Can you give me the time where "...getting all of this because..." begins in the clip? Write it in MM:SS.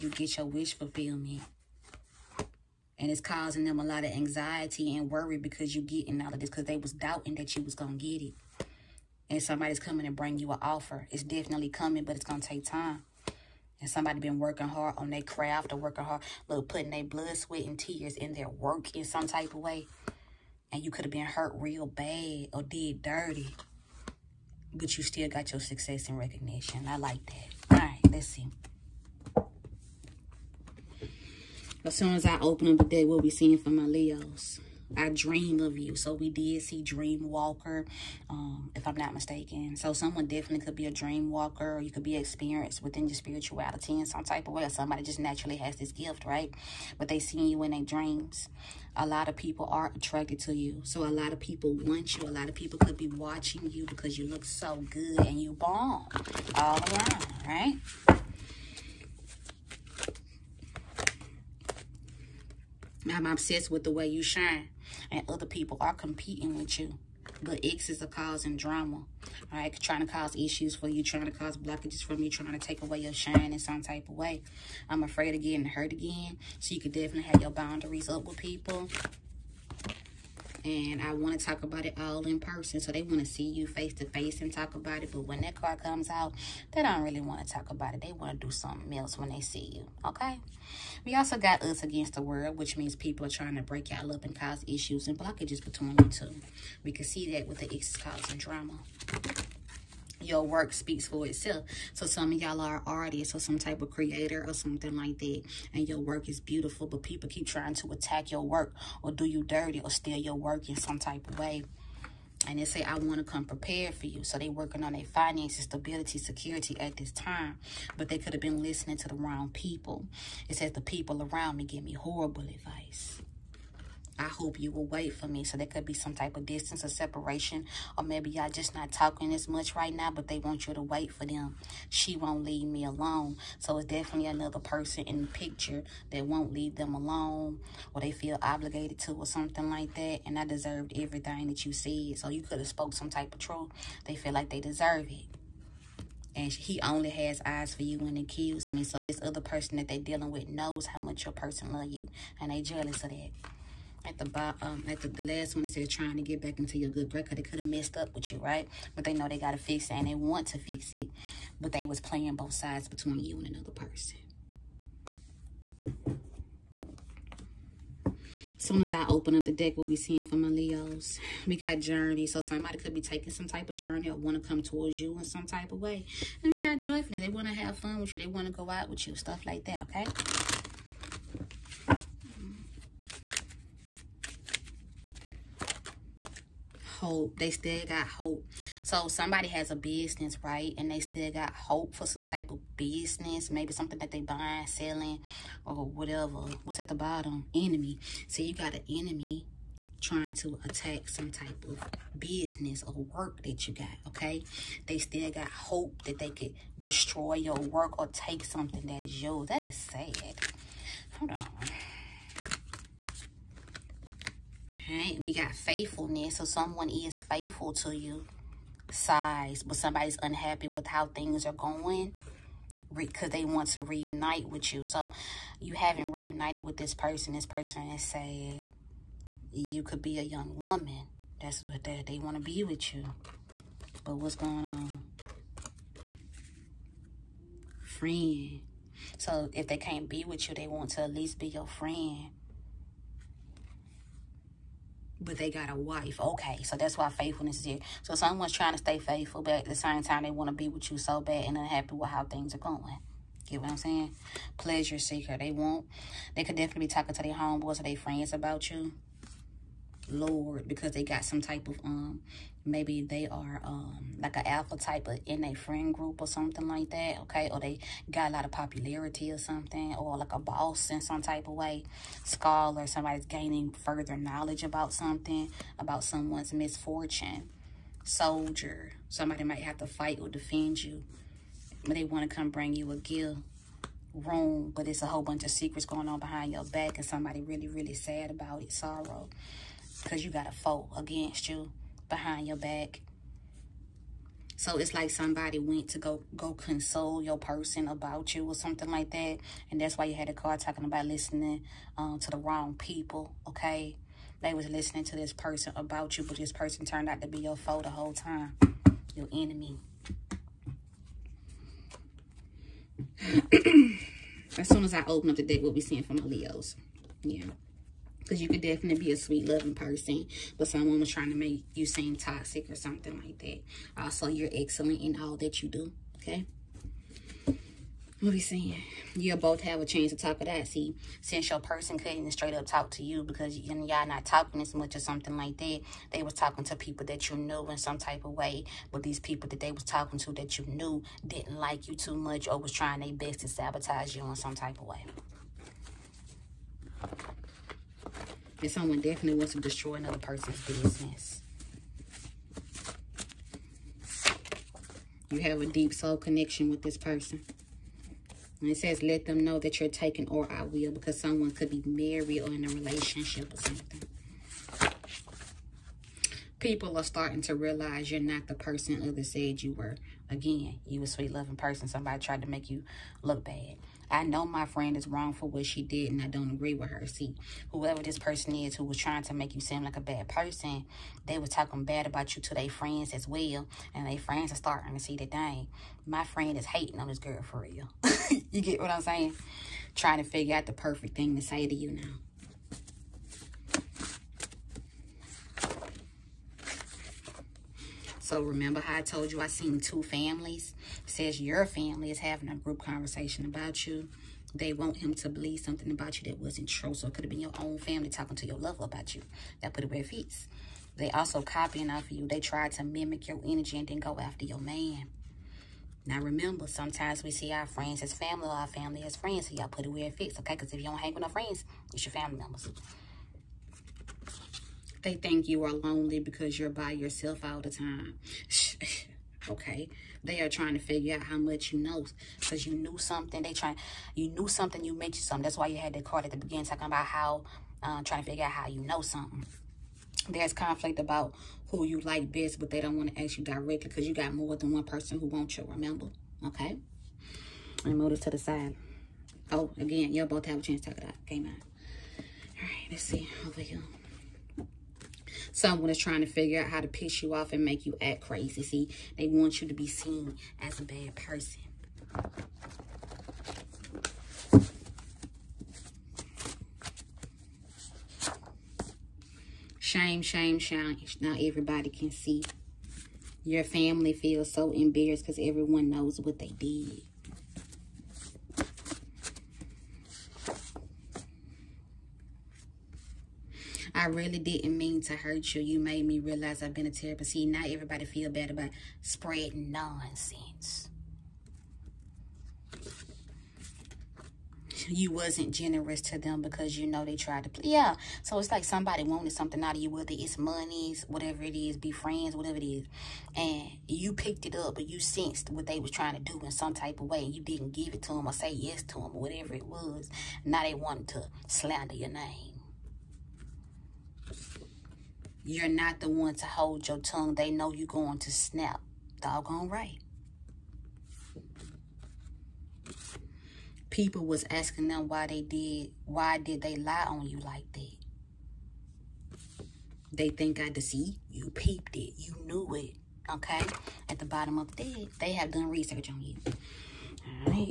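00:05.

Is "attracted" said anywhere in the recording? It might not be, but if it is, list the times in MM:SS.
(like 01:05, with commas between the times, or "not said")
00:49.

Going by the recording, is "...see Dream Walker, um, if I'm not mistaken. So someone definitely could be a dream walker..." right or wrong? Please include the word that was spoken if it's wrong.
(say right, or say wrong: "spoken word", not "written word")
right.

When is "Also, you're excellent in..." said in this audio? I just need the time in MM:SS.
05:24.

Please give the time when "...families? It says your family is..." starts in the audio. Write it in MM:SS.
06:40.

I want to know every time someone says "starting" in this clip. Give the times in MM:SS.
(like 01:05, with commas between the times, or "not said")
06:07, 06:24.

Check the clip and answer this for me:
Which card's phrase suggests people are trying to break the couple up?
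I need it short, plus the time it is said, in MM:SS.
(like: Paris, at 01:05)
Us against the world, at 01:31.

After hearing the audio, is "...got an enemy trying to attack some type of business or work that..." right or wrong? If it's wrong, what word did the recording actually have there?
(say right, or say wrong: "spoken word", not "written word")
right.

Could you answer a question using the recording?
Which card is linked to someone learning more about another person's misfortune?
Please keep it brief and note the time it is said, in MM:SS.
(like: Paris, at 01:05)
Scholar, at 04:32.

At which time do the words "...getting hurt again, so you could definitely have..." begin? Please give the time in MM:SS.
01:15.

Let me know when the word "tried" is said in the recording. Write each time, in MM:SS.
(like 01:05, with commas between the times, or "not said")
06:12, 08:17.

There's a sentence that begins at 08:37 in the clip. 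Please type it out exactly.
They know you're going to snap.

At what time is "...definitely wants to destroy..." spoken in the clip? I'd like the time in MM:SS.
05:48.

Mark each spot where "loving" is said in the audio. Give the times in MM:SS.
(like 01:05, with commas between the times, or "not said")
05:19, 06:11.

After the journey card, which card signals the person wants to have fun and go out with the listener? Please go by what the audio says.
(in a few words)
Joyfulness.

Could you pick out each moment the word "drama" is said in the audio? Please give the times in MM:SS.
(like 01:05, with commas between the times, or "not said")
01:08, 01:38.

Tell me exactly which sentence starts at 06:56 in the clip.
Now remember, sometimes we see our friends as family or our family as friends.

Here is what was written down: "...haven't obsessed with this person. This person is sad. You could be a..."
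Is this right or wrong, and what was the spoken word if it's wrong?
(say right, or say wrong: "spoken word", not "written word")
wrong: "reunited", not "obsessed".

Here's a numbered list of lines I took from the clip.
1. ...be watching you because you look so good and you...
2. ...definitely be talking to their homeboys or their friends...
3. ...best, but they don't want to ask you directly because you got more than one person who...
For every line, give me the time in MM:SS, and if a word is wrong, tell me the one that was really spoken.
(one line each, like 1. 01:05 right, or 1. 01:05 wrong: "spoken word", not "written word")
1. 00:52 right
2. 04:16 right
3. 07:22 right.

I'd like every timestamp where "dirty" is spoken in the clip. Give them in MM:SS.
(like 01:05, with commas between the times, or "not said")
00:23, 01:49.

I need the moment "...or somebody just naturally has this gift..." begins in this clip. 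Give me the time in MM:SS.
00:44.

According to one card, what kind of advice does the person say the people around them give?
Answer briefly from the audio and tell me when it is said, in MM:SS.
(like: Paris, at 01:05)
Horrible advice, at 02:01.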